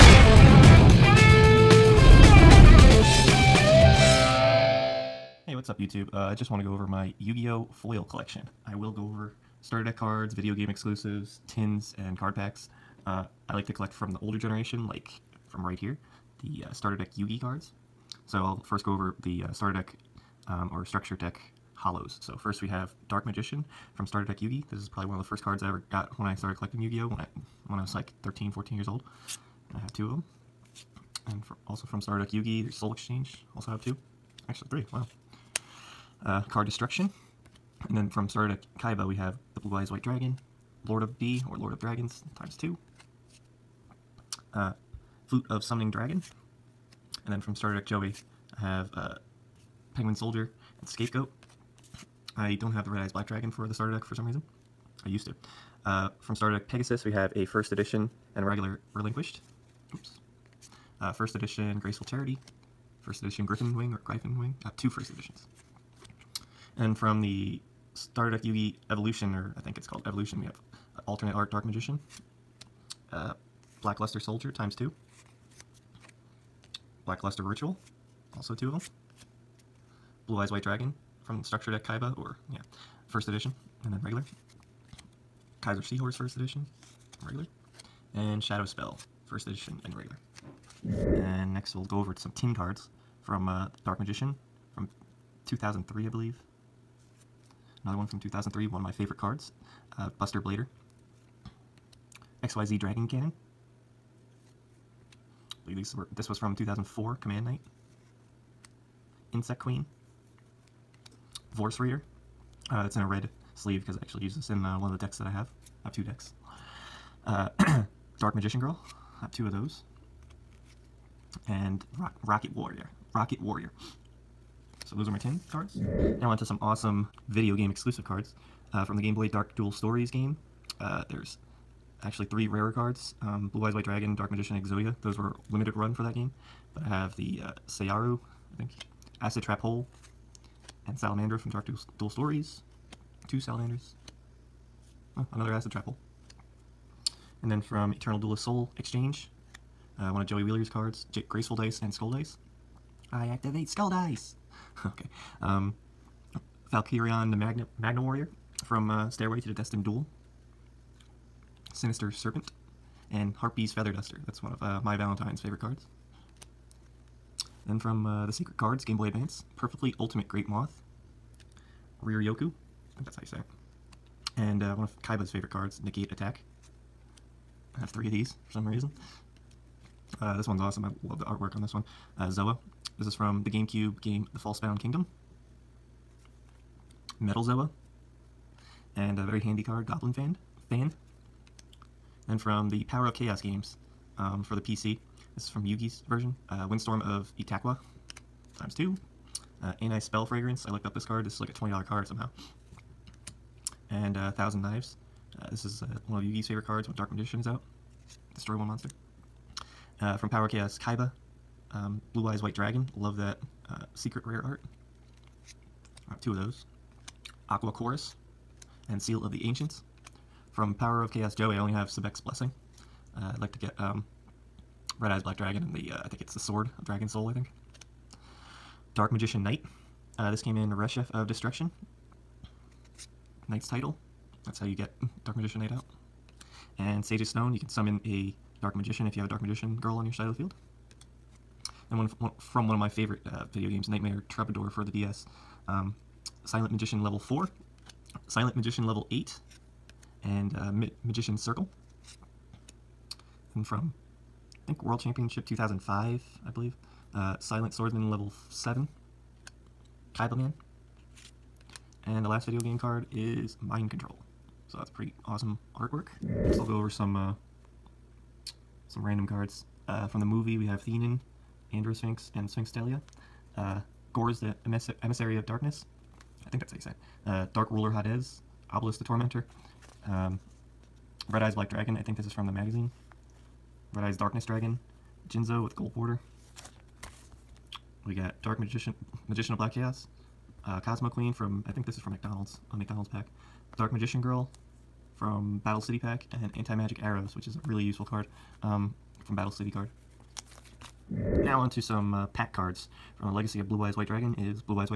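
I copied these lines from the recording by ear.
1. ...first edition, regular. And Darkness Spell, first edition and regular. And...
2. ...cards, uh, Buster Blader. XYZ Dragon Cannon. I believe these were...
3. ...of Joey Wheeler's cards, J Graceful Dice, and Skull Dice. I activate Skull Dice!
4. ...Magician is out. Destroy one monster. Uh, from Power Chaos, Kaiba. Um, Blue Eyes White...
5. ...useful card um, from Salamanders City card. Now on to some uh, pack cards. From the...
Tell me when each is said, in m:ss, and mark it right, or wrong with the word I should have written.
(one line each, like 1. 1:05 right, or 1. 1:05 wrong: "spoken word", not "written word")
1. 1:26 wrong: "Shadow", not "Darkness"
2. 1:39 right
3. 2:30 right
4. 3:27 right
5. 4:57 wrong: "Battle", not "Salamanders".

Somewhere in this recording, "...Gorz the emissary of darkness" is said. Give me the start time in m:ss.
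4:34.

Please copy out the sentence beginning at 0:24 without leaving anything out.
This is probably one of the first cards I ever got when I started collecting Yu-Gi-Oh!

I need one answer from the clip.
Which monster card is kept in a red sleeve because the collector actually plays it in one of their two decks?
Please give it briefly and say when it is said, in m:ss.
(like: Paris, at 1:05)
Vorse Raider, at 1:51.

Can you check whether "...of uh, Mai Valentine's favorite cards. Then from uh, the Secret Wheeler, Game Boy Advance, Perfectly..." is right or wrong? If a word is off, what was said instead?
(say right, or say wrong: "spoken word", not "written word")
wrong: "Cards", not "Wheeler".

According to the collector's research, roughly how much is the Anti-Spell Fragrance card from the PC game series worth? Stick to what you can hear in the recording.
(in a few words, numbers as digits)
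$20.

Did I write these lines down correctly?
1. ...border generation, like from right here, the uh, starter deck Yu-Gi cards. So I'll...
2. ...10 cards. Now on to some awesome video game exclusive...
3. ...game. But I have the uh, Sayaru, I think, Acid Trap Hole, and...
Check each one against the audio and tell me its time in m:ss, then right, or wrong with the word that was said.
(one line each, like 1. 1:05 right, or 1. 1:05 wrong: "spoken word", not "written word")
1. 0:14 wrong: "older", not "border"
2. 2:05 right
3. 2:16 right.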